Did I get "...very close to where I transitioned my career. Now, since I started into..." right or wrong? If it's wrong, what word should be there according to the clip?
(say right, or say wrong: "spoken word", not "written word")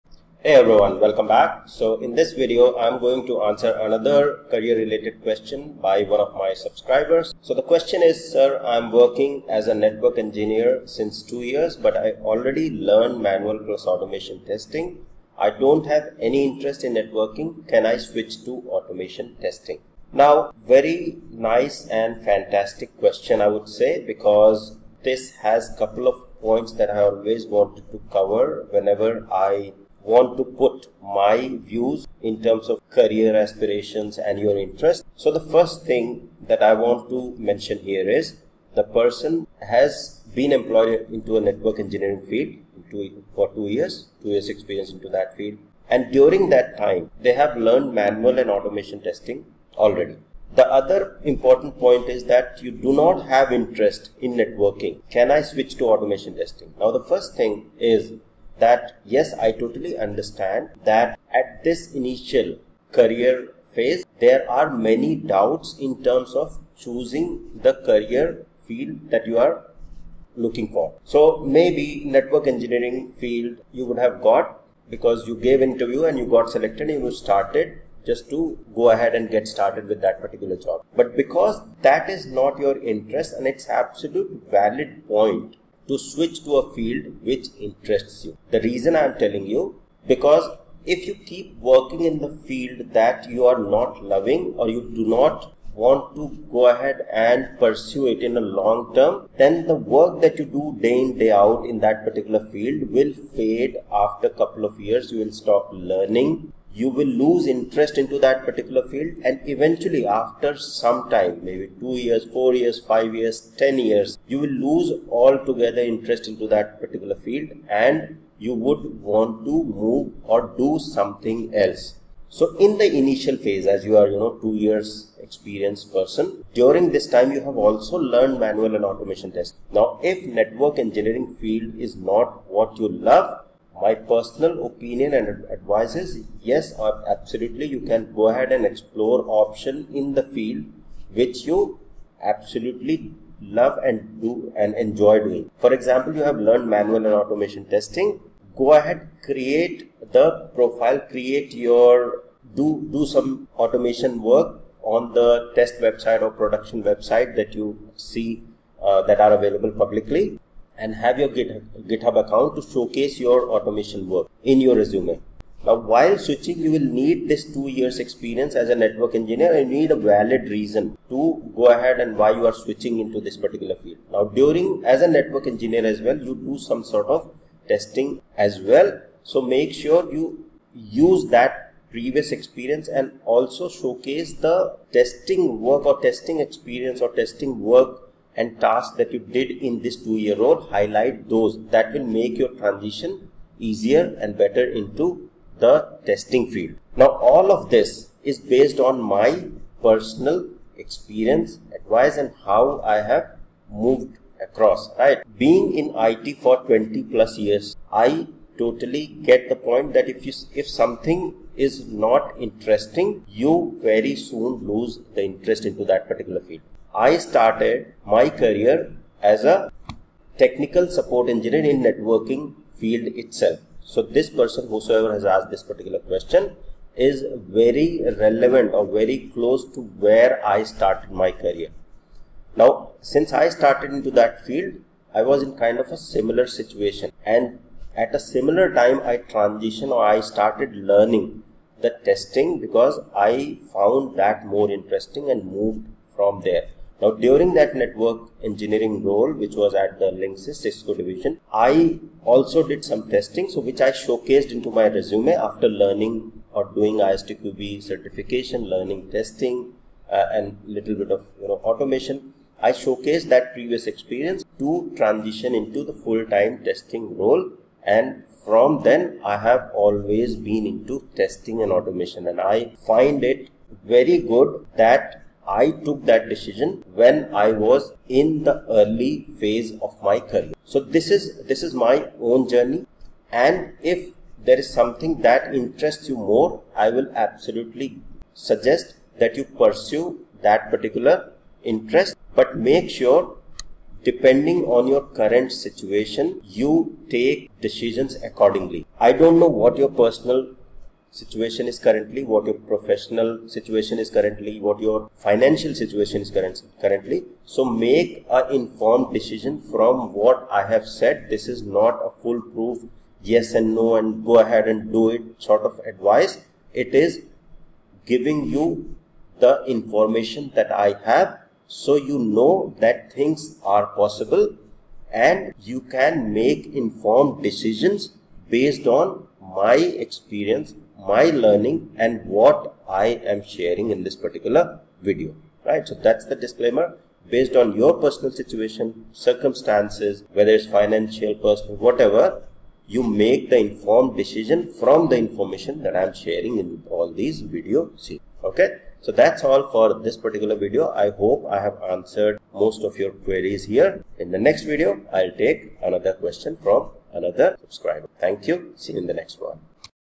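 wrong: "started", not "transitioned".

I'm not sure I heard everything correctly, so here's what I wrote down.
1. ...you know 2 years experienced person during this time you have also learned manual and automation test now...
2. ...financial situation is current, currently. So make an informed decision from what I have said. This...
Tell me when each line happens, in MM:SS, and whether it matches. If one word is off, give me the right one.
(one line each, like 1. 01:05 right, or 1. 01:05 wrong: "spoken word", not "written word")
1. 02:04 right
2. 05:05 right.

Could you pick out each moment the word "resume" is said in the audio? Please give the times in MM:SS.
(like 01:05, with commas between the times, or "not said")
02:44, 04:14.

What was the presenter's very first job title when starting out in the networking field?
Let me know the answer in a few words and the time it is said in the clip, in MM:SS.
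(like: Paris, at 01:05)
Technical support engineer, at 03:40.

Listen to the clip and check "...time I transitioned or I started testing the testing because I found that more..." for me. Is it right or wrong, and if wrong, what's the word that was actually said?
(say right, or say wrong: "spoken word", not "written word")
wrong: "learning", not "testing".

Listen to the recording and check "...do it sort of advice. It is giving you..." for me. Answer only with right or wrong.
right.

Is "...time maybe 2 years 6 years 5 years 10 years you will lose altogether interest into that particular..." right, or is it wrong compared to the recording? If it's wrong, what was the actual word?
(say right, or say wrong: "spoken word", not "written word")
wrong: "4", not "6".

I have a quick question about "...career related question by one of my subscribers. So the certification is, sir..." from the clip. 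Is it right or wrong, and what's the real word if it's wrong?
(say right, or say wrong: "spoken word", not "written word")
wrong: "question", not "certification".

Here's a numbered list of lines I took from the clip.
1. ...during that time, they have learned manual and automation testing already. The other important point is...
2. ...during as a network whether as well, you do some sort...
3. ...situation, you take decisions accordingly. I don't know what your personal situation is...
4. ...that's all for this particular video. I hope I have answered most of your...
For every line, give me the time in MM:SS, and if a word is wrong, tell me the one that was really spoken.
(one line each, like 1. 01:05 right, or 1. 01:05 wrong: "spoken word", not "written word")
1. 00:46 right
2. 02:54 wrong: "engineer", not "whether"
3. 04:55 right
4. 05:49 right.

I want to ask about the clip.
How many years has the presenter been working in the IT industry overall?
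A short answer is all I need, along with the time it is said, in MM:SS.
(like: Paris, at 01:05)
20 plus years, at 03:26.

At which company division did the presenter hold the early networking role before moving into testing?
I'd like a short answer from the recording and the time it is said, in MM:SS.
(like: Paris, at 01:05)
Linksys Cisco division, at 04:10.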